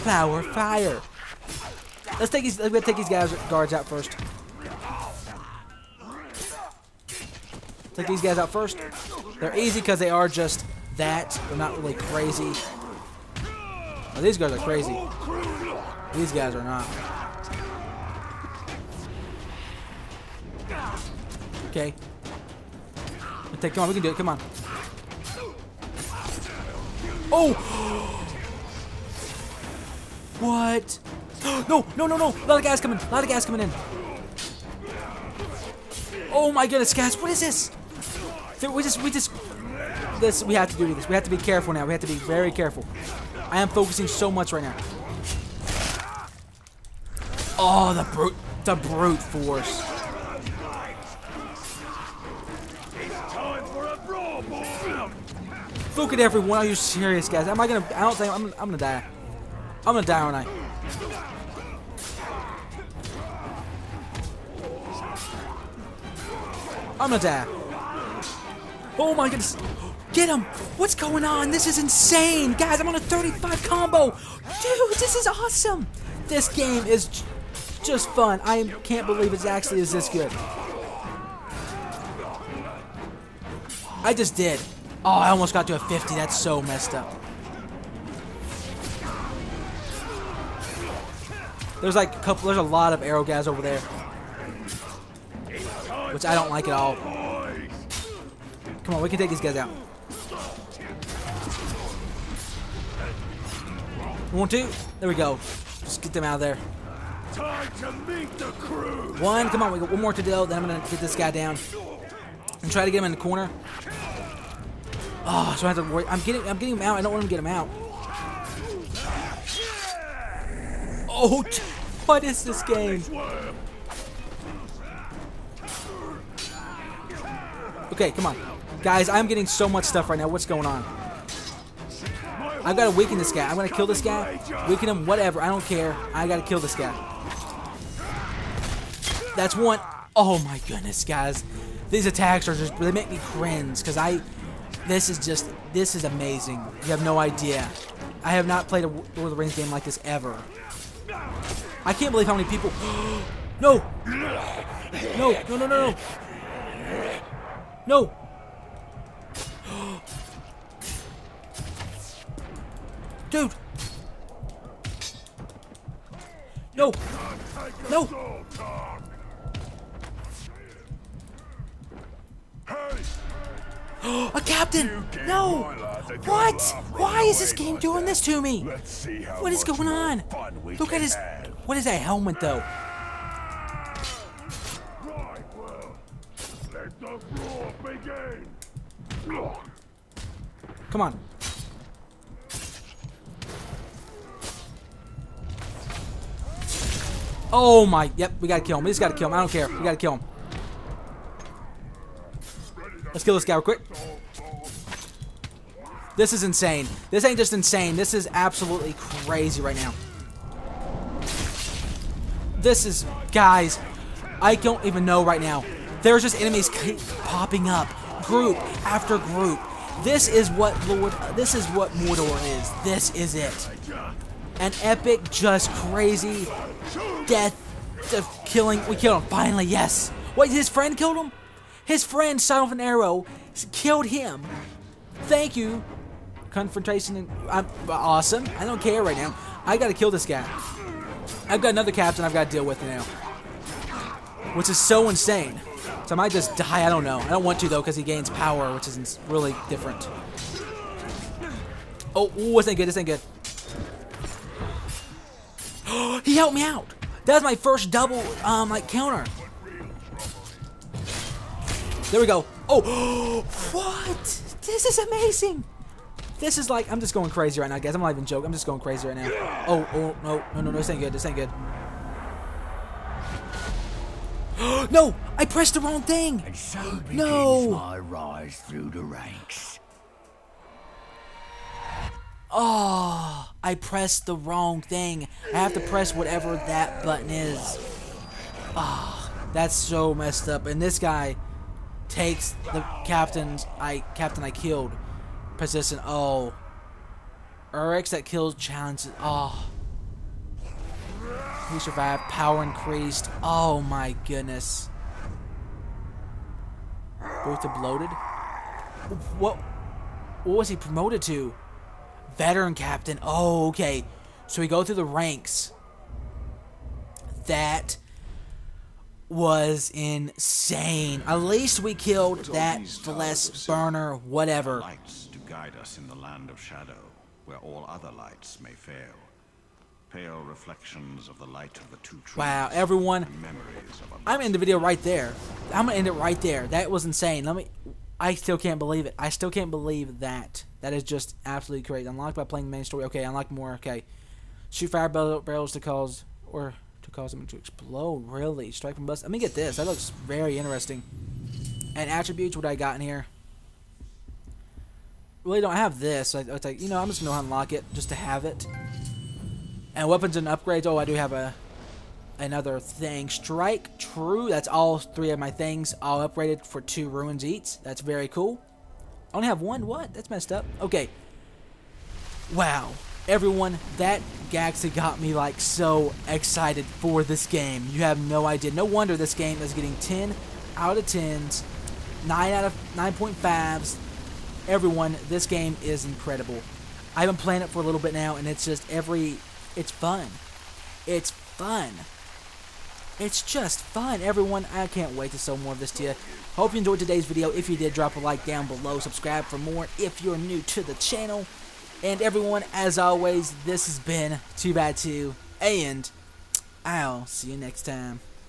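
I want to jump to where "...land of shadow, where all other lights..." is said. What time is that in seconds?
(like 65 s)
326 s.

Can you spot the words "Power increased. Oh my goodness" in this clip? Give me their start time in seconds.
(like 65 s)
302 s.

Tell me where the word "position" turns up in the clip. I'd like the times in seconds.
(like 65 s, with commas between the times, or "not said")
295 s.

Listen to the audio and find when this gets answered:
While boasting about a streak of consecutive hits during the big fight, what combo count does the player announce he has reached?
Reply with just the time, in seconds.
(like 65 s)
73 s.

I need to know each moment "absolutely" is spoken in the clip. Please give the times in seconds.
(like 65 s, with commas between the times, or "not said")
208 s, 341 s.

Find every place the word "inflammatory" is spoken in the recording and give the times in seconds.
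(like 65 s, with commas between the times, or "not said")
not said.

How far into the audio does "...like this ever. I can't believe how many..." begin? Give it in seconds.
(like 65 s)
149 s.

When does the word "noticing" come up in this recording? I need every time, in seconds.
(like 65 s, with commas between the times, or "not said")
not said.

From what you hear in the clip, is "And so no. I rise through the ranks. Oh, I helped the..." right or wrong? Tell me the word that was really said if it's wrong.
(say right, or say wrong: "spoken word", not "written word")
wrong: "pressed", not "helped".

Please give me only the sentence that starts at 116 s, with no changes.
I'm getting I'm getting him out.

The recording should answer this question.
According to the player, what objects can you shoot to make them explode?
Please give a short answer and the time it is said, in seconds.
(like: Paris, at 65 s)
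Fire barrels, at 344 s.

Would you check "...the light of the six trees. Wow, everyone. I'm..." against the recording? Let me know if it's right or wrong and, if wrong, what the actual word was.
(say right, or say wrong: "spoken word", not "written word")
wrong: "two", not "six".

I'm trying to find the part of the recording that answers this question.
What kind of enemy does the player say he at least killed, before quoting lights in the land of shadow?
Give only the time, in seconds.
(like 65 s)
322 s.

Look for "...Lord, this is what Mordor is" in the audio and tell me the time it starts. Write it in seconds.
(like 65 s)
220 s.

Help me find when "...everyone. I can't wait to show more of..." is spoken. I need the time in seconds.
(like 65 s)
394 s.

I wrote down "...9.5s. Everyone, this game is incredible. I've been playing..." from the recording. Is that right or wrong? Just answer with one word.
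right.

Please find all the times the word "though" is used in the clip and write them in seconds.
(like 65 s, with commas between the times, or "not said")
182 s, 247 s.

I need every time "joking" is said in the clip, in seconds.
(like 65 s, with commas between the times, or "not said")
268 s.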